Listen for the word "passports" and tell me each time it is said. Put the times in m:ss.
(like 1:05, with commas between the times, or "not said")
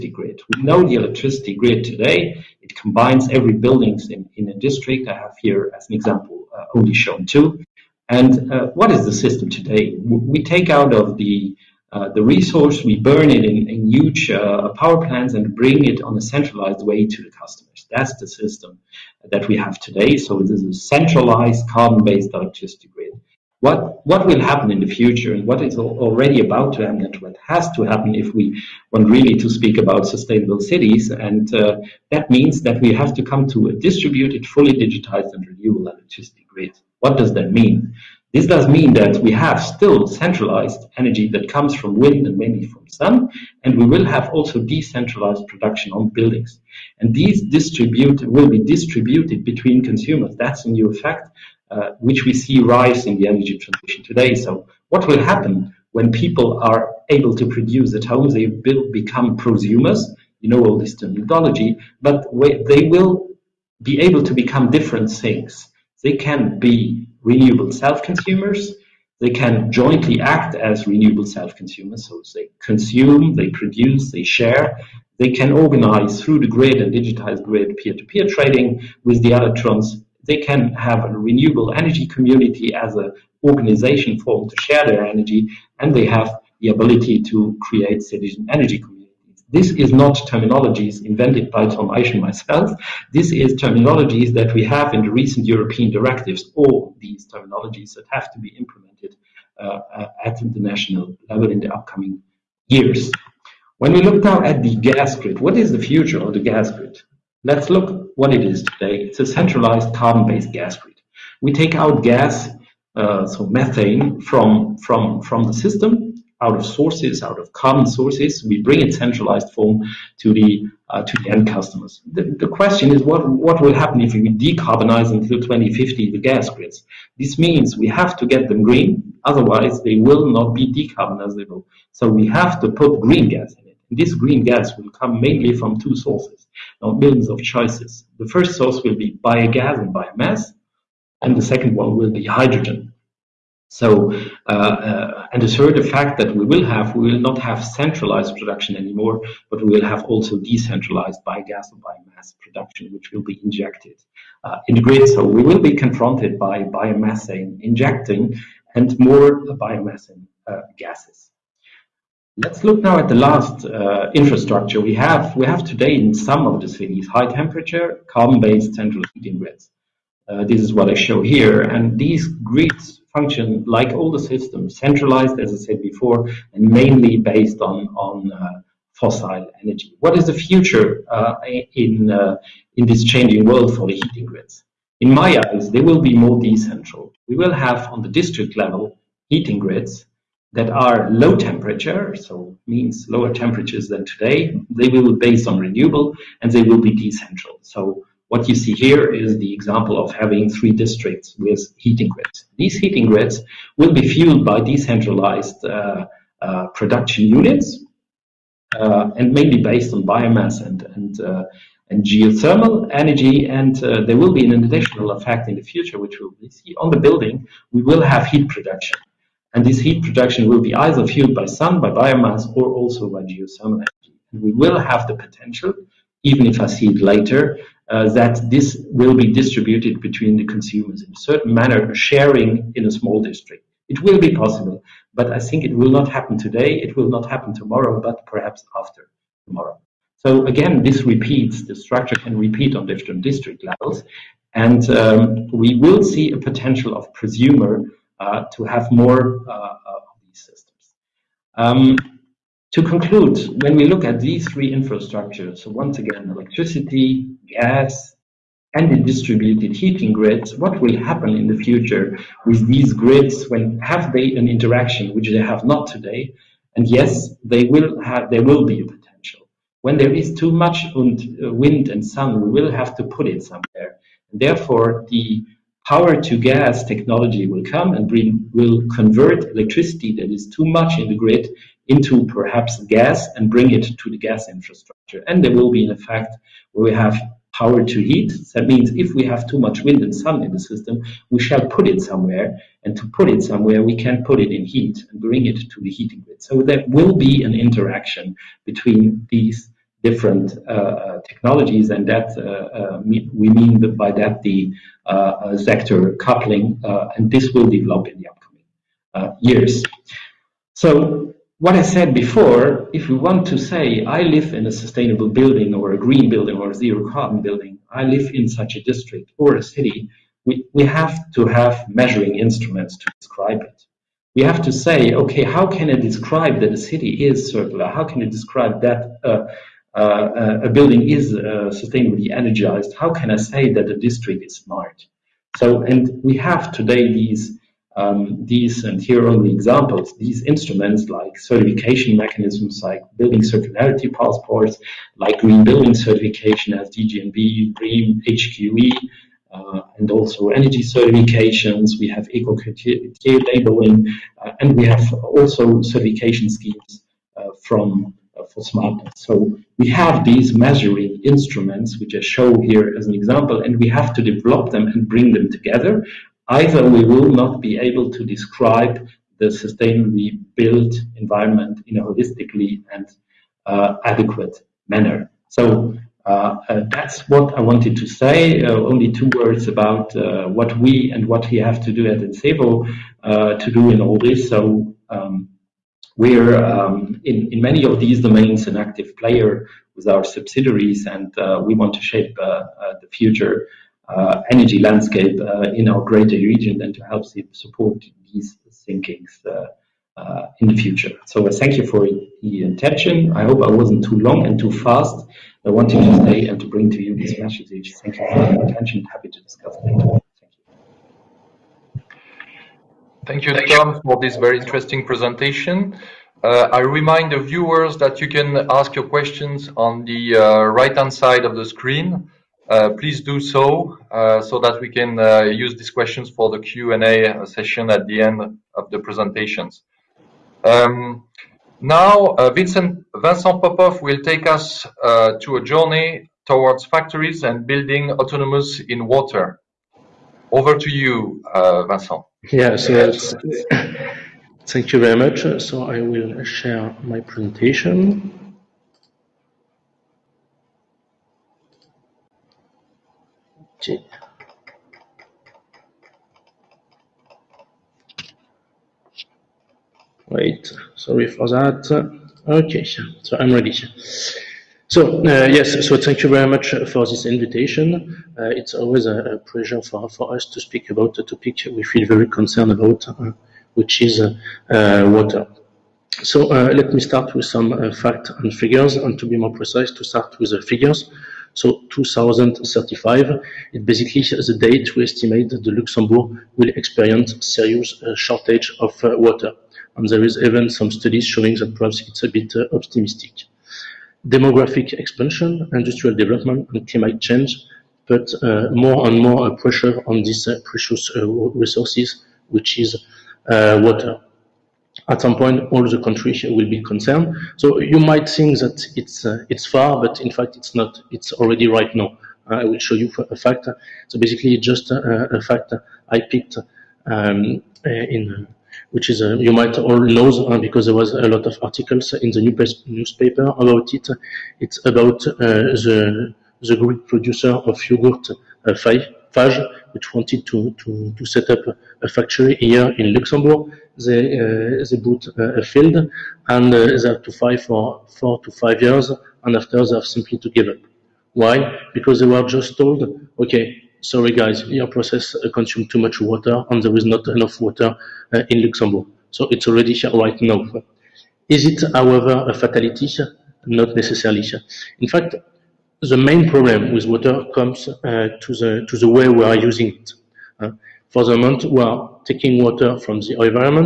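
5:44.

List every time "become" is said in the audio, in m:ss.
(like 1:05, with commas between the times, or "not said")
0:58, 1:04.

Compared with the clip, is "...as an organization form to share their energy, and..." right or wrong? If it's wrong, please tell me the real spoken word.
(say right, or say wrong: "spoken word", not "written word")
right.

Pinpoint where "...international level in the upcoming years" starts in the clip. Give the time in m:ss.
1:40.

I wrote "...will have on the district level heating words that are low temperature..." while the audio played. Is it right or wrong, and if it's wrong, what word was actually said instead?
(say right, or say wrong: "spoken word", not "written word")
wrong: "grids", not "words".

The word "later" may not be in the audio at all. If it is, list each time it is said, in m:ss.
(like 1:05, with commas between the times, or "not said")
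3:46, 6:49.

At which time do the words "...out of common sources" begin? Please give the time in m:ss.
1:57.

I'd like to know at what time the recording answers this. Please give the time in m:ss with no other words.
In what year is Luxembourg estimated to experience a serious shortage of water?
8:01.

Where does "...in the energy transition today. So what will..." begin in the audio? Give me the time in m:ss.
0:53.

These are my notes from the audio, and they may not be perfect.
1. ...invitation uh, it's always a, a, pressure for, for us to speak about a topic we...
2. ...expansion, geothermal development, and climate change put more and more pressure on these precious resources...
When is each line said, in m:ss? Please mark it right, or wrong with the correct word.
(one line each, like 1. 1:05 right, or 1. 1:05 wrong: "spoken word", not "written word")
1. 7:47 wrong: "pleasure", not "pressure"
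2. 8:14 wrong: "industrial", not "geothermal".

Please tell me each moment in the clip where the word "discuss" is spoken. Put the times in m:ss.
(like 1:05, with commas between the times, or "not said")
6:49.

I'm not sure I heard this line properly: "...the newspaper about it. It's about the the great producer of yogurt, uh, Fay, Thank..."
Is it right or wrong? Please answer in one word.
wrong.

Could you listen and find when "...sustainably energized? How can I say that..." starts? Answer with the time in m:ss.
5:31.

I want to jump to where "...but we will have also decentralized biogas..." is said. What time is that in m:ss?
2:29.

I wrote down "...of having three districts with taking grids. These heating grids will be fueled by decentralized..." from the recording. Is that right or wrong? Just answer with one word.
wrong.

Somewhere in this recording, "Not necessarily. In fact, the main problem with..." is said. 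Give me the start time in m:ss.
9:13.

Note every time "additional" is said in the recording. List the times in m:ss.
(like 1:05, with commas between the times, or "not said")
3:34.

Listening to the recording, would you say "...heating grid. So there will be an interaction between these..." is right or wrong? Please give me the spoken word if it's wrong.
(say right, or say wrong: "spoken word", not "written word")
right.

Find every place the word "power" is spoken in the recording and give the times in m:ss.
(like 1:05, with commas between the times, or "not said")
0:14, 4:35, 4:47.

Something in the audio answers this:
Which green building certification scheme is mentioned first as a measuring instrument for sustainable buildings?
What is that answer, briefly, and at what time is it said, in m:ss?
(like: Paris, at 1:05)
DGNB, at 5:46.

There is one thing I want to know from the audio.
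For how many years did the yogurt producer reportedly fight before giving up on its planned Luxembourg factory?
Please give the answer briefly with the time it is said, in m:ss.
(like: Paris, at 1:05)
four to five years, at 8:58.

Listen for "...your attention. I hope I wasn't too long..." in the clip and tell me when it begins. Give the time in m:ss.
6:42.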